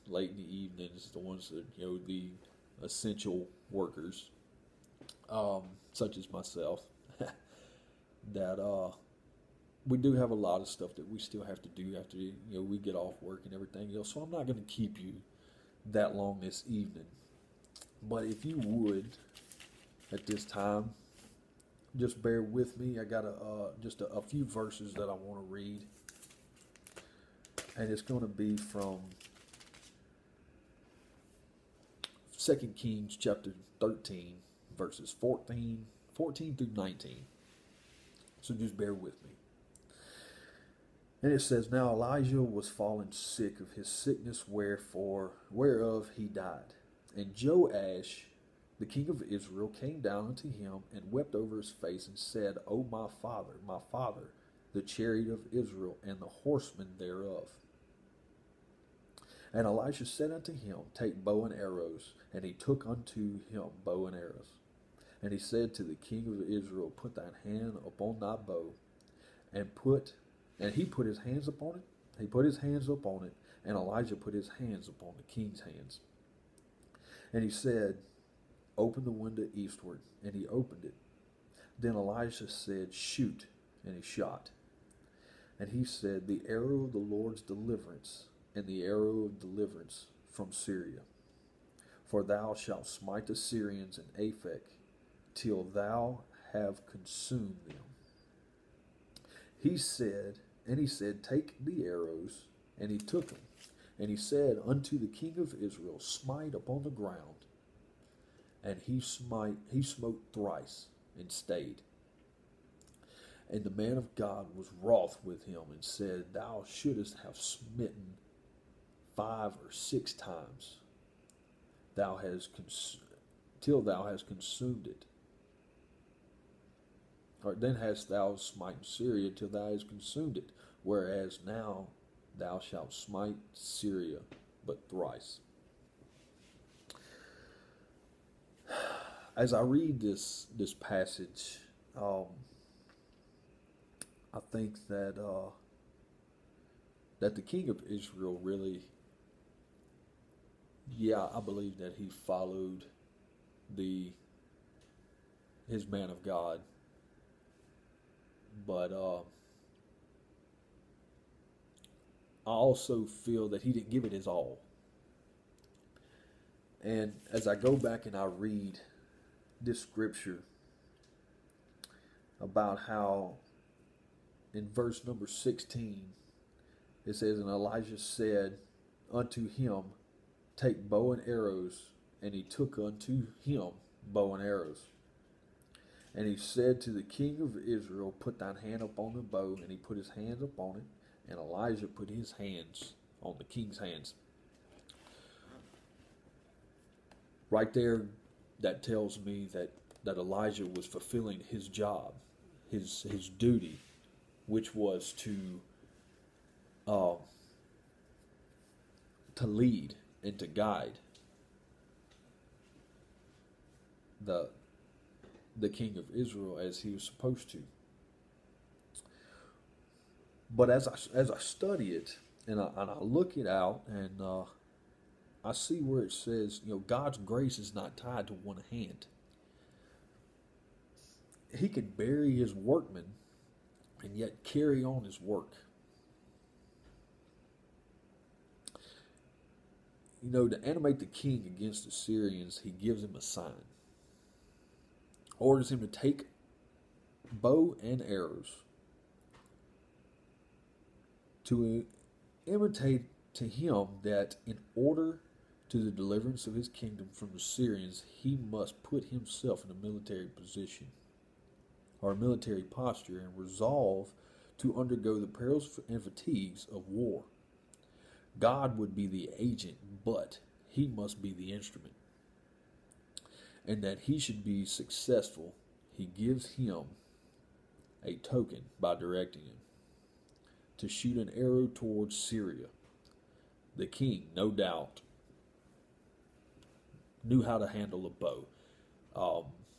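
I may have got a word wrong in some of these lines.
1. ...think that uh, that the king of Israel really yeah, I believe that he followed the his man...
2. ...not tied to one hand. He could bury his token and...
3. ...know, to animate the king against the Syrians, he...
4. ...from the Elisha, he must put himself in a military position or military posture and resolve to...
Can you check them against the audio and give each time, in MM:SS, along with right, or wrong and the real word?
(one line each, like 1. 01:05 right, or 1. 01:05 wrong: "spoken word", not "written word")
1. 02:24 right
2. 03:47 wrong: "workmen", not "token"
3. 04:00 right
4. 04:17 wrong: "Syrians", not "Elisha".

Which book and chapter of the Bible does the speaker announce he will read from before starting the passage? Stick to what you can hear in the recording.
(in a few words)
2 Kings 13.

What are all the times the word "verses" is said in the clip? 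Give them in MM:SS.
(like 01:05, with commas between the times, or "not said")
00:24, 00:34, 02:54.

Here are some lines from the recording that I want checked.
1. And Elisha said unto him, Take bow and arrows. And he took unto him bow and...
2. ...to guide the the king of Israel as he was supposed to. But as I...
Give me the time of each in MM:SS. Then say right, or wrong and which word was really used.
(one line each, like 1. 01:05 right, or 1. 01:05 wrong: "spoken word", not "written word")
1. 00:59 right
2. 03:30 right.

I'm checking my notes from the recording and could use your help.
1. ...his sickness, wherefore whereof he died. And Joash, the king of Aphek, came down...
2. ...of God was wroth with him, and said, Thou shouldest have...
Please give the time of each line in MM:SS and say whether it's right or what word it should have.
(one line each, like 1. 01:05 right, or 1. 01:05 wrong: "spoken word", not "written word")
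1. 00:43 wrong: "Israel", not "Aphek"
2. 01:53 right.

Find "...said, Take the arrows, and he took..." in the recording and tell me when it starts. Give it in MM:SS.
01:40.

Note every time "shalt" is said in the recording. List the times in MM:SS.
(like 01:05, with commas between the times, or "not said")
01:32, 02:12.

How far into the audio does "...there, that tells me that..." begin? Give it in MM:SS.
03:17.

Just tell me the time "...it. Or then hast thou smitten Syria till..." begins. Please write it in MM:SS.
02:04.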